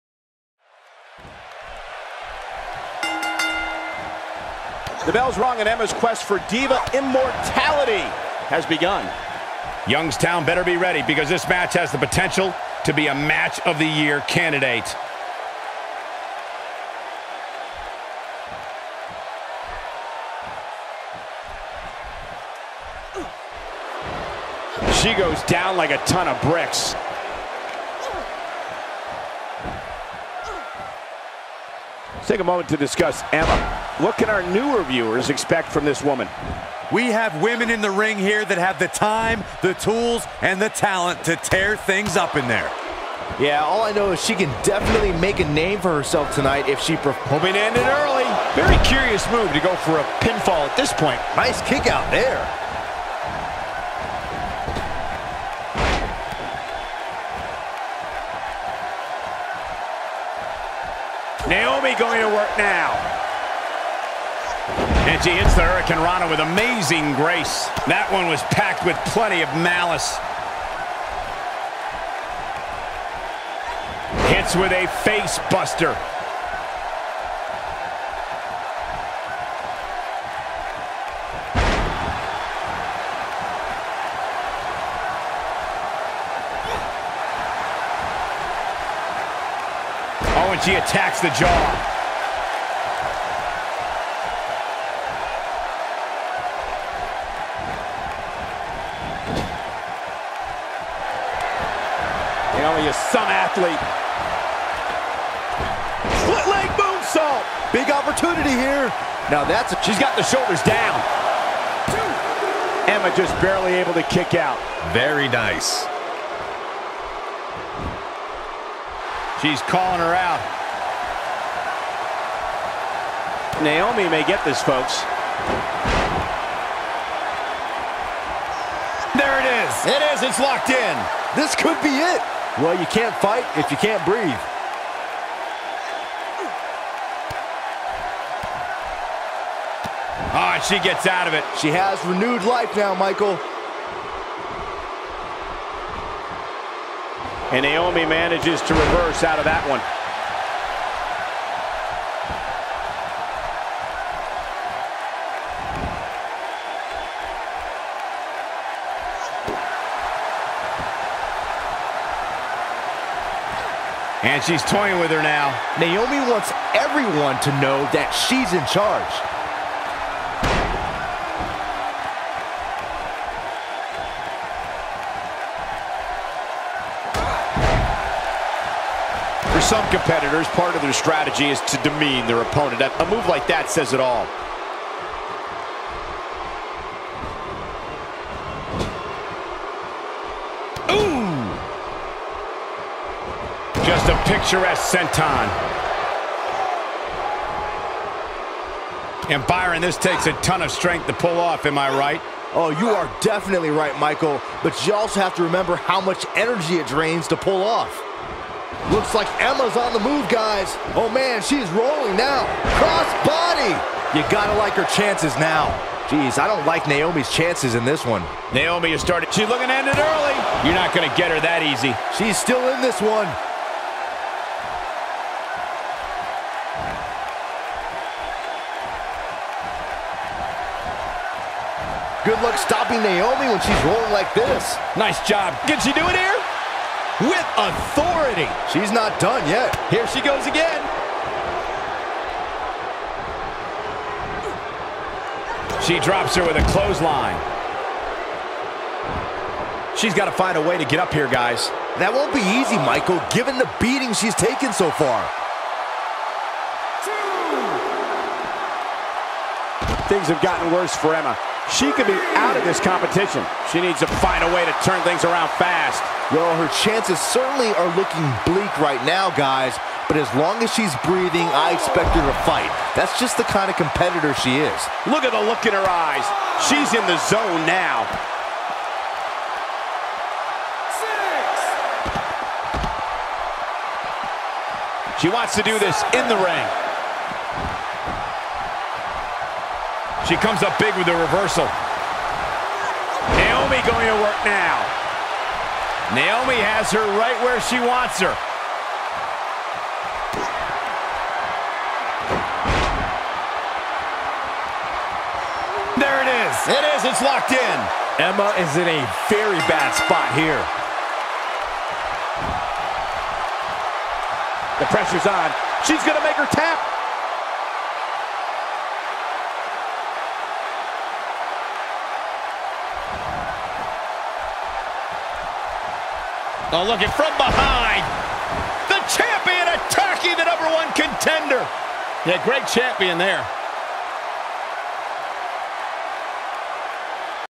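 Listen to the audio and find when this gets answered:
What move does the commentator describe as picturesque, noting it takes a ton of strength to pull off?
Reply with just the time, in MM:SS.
03:14.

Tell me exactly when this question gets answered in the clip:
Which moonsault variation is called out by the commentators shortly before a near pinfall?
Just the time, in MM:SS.
01:46.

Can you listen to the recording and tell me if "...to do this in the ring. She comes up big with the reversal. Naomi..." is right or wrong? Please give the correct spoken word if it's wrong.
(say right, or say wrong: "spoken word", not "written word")
right.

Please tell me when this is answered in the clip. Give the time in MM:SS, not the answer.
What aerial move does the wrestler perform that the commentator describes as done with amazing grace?
01:05.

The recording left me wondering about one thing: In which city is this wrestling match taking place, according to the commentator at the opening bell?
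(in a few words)
Youngstown.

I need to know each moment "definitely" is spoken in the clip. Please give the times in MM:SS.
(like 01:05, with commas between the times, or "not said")
00:44, 03:23.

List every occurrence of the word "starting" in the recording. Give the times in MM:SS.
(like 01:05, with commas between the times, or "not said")
03:39.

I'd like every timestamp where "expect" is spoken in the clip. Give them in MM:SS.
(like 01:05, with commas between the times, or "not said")
00:35, 04:31.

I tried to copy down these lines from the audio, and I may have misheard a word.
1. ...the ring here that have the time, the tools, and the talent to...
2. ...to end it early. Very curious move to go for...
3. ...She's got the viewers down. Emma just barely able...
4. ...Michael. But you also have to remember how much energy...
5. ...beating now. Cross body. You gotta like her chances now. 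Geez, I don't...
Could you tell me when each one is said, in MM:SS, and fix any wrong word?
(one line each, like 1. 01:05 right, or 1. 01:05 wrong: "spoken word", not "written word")
1. 00:37 right
2. 00:47 right
3. 01:49 wrong: "shoulders", not "viewers"
4. 03:23 right
5. 03:31 wrong: "rolling", not "beating".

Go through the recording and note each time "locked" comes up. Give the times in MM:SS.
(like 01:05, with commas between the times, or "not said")
02:10, 05:07.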